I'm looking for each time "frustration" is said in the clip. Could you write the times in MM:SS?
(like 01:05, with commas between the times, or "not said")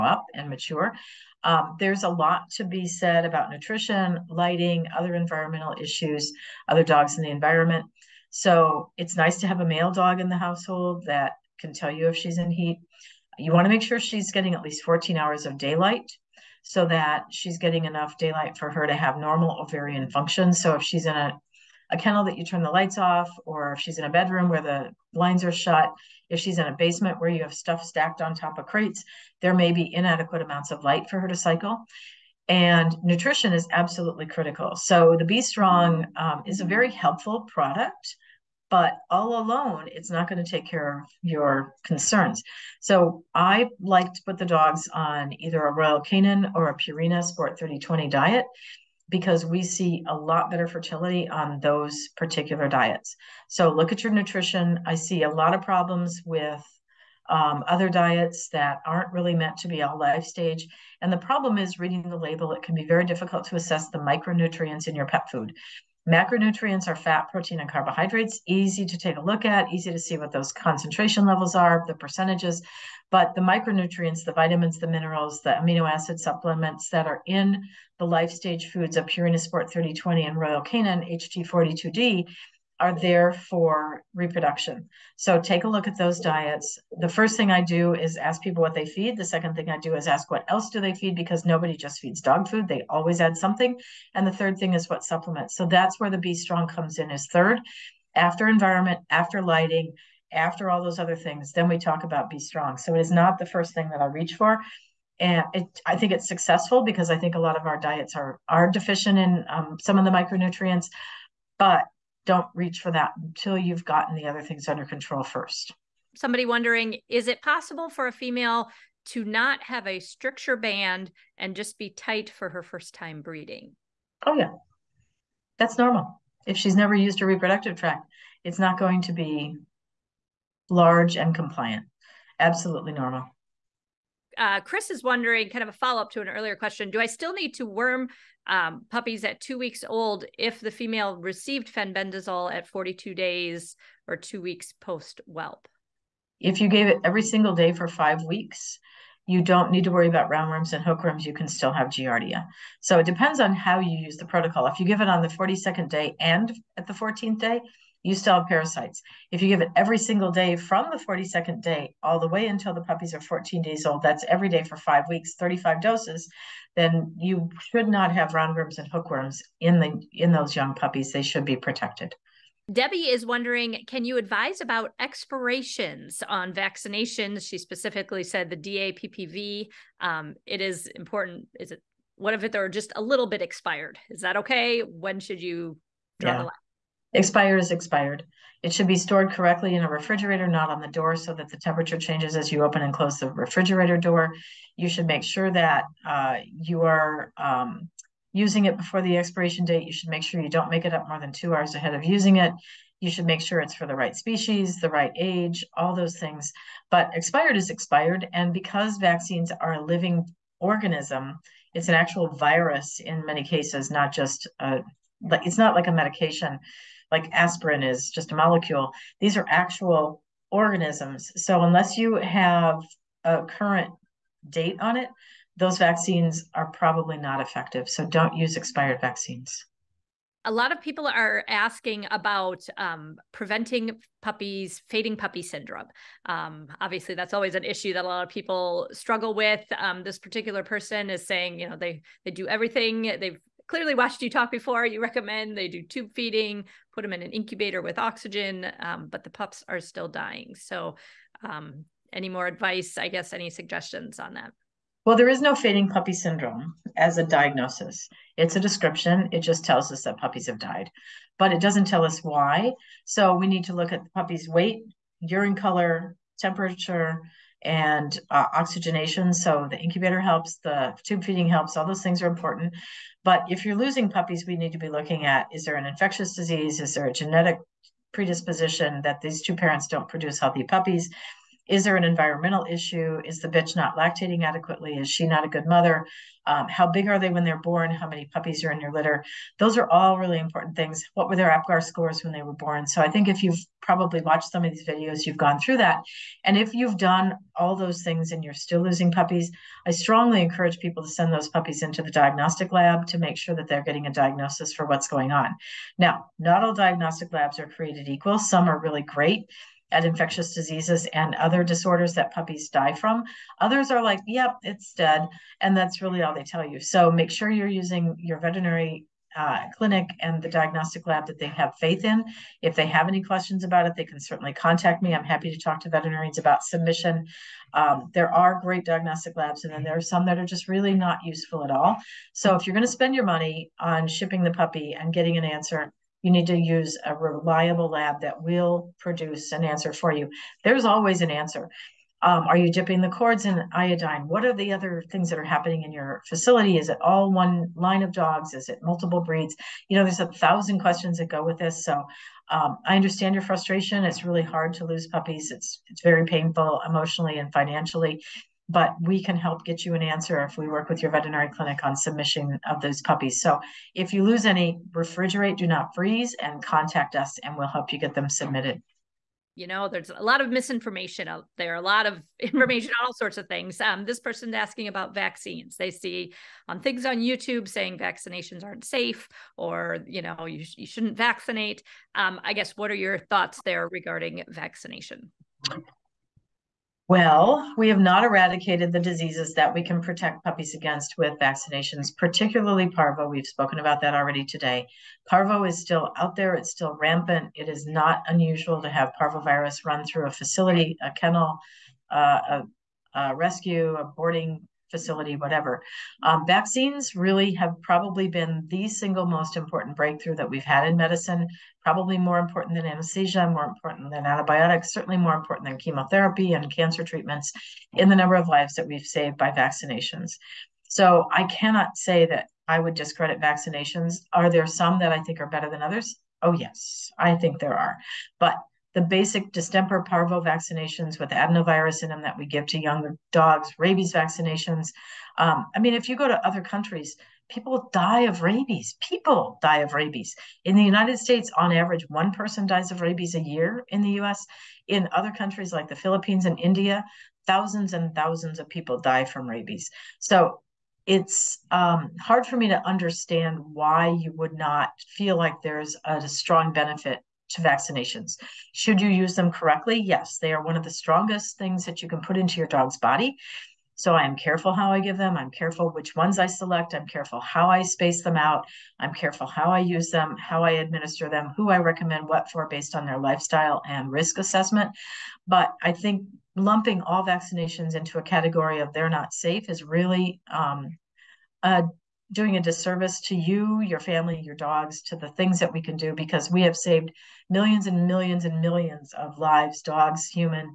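05:53.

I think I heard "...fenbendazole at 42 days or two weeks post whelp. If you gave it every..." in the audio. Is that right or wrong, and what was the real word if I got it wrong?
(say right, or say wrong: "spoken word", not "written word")
right.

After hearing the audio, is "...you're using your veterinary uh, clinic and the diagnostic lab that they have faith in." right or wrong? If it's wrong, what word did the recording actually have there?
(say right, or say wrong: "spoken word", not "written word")
right.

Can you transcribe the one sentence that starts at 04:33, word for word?
But if you're losing puppies, we need to be looking at is there an infectious disease?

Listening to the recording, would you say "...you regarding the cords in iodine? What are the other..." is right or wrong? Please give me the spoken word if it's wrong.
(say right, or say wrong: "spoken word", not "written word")
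wrong: "dipping", not "regarding".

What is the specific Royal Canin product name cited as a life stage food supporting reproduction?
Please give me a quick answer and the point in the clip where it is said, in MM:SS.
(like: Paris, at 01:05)
Royal Canin HT42D, at 01:20.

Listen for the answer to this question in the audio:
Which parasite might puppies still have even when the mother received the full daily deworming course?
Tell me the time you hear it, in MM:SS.
02:31.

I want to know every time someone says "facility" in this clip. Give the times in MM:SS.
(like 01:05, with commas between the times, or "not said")
05:46, 06:40, 06:44.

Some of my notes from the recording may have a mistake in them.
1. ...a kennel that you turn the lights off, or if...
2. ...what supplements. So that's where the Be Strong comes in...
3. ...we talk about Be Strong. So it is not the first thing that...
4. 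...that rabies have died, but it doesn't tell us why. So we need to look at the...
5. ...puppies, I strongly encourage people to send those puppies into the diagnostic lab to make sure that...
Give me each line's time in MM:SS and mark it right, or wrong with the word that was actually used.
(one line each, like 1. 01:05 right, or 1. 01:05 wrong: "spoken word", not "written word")
1. 00:21 right
2. 01:34 right
3. 01:41 right
4. 04:20 wrong: "puppies", not "rabies"
5. 04:59 right.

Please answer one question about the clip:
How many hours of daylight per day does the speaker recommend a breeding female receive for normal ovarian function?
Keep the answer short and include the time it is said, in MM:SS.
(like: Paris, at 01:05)
14, at 00:14.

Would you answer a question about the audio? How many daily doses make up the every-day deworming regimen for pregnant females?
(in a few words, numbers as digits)
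35.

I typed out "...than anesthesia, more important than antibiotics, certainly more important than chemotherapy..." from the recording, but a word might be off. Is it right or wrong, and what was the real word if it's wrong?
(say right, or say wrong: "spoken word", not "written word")
right.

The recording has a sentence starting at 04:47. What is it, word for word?
How many puppies are in your litter?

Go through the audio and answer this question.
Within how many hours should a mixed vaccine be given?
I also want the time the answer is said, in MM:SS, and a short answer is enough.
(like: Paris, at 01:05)
2 hours, at 03:21.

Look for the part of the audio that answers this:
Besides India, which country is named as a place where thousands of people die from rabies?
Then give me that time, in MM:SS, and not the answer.
07:25.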